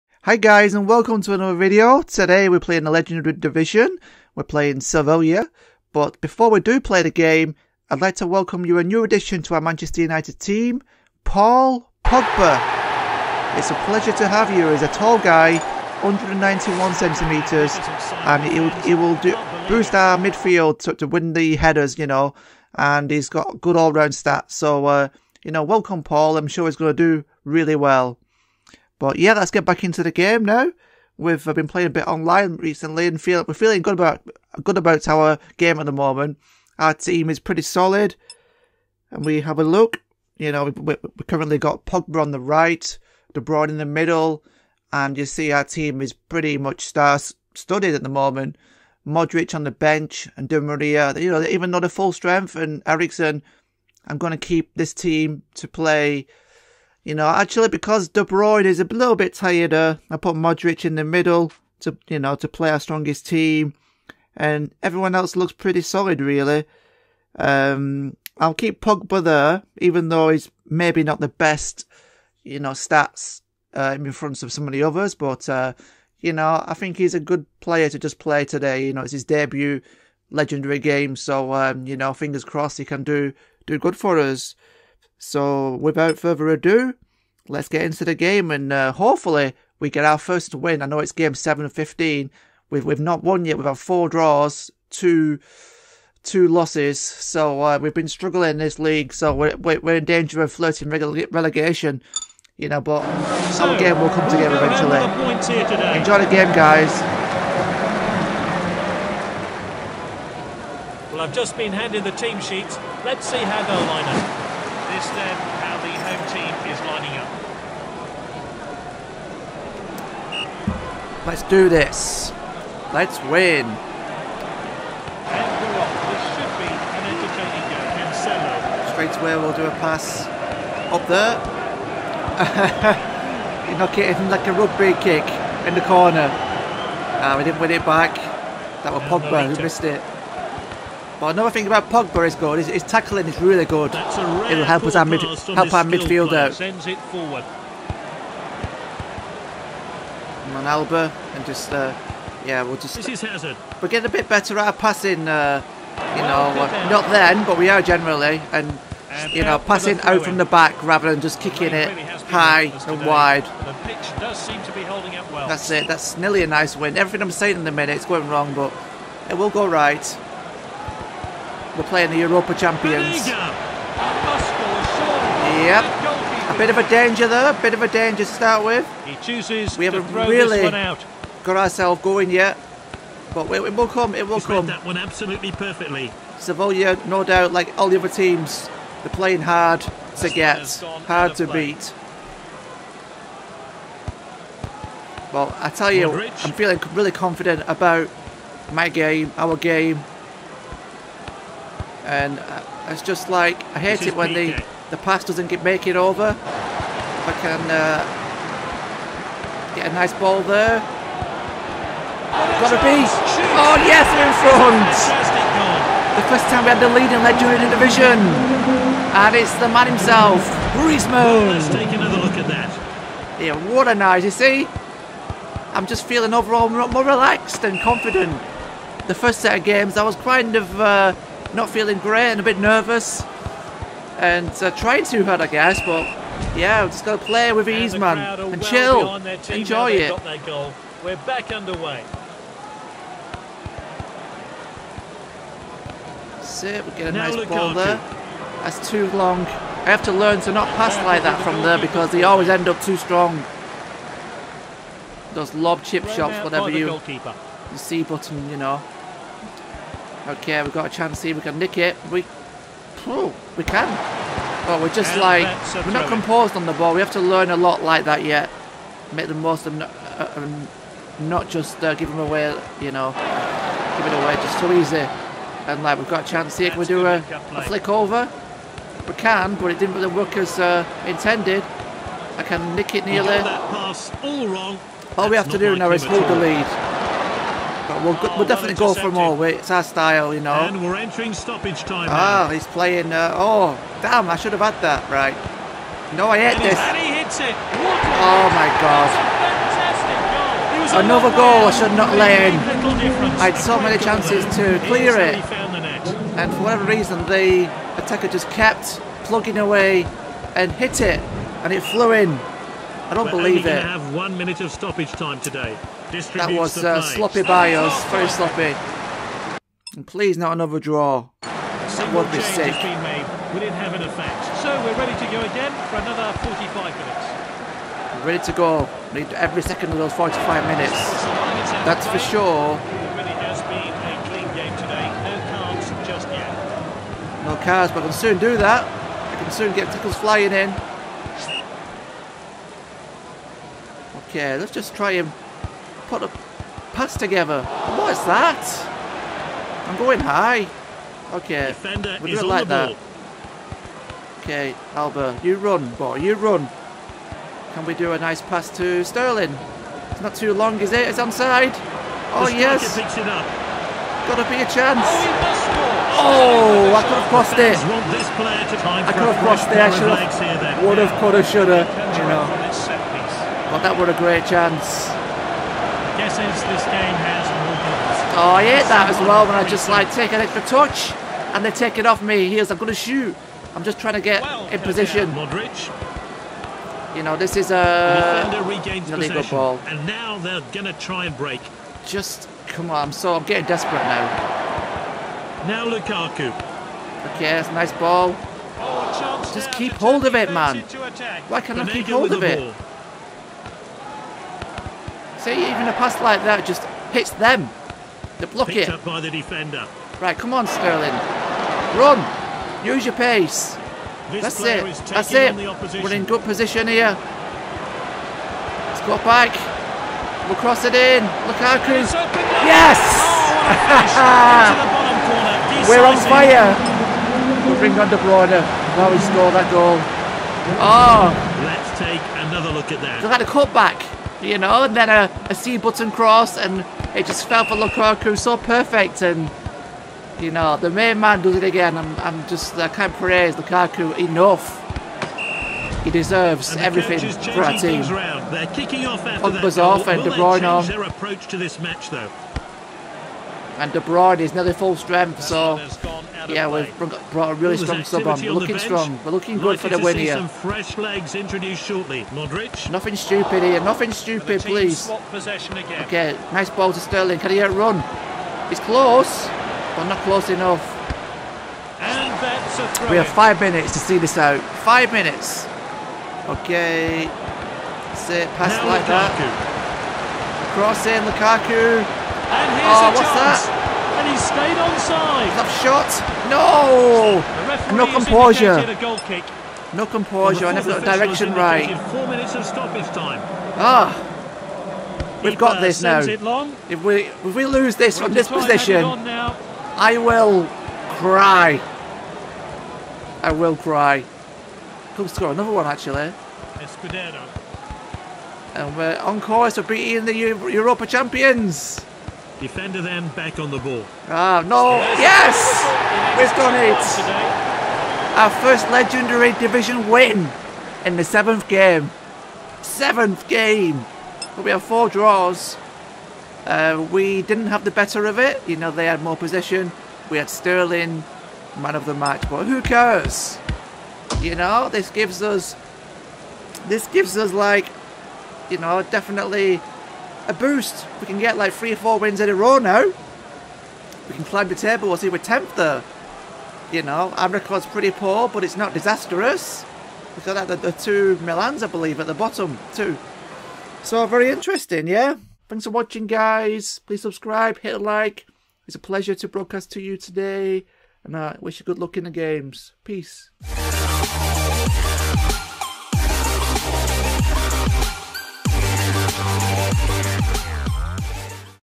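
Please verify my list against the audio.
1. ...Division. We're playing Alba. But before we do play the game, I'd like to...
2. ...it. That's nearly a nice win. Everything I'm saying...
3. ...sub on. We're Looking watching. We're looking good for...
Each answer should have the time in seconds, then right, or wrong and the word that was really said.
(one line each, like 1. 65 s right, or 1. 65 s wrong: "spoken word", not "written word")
1. 3 s wrong: "Sevilla", not "Alba"
2. 165 s right
3. 458 s wrong: "strong", not "watching".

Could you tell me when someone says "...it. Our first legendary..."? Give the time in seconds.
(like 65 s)
516 s.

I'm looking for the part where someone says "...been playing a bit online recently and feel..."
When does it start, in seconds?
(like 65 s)
31 s.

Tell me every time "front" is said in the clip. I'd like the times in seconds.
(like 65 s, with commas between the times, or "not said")
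74 s, 214 s.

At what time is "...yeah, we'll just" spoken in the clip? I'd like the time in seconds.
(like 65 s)
152 s.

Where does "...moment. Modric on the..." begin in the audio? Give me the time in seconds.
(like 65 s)
48 s.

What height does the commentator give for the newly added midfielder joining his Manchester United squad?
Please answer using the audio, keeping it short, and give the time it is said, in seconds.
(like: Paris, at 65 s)
191 centimetres, at 16 s.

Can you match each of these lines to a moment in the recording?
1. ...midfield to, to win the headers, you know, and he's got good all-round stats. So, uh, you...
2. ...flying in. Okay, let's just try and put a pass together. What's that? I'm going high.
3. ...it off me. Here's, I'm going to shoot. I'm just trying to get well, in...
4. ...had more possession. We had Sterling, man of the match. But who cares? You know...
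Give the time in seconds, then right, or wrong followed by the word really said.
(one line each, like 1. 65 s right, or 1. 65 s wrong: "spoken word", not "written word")
1. 20 s right
2. 340 s right
3. 381 s right
4. 529 s right.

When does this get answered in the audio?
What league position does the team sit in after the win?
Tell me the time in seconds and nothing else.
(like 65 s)
545 s.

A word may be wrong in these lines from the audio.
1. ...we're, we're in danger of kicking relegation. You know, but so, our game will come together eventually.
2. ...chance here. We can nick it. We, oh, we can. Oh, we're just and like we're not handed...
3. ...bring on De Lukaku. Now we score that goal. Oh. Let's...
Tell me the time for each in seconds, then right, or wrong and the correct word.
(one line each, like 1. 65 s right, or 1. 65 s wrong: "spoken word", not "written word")
1. 99 s wrong: "flirting", not "kicking"
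2. 260 s wrong: "composed", not "handed"
3. 427 s wrong: "Bruyne", not "Lukaku".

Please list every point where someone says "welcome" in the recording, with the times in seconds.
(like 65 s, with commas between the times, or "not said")
0 s, 8 s, 25 s.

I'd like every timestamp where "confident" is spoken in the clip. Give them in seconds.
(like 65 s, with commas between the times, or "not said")
197 s, 227 s.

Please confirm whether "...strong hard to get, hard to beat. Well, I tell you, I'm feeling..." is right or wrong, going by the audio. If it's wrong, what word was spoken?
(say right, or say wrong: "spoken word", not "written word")
wrong: "playing", not "strong".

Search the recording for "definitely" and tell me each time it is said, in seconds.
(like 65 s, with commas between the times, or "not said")
288 s, 539 s.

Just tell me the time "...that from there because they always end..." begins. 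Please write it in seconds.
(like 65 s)
251 s.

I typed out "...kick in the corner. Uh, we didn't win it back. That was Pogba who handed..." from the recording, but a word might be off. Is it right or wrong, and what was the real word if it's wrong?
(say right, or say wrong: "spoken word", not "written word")
wrong: "missed", not "handed".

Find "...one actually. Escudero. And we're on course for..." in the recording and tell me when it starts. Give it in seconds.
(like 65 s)
505 s.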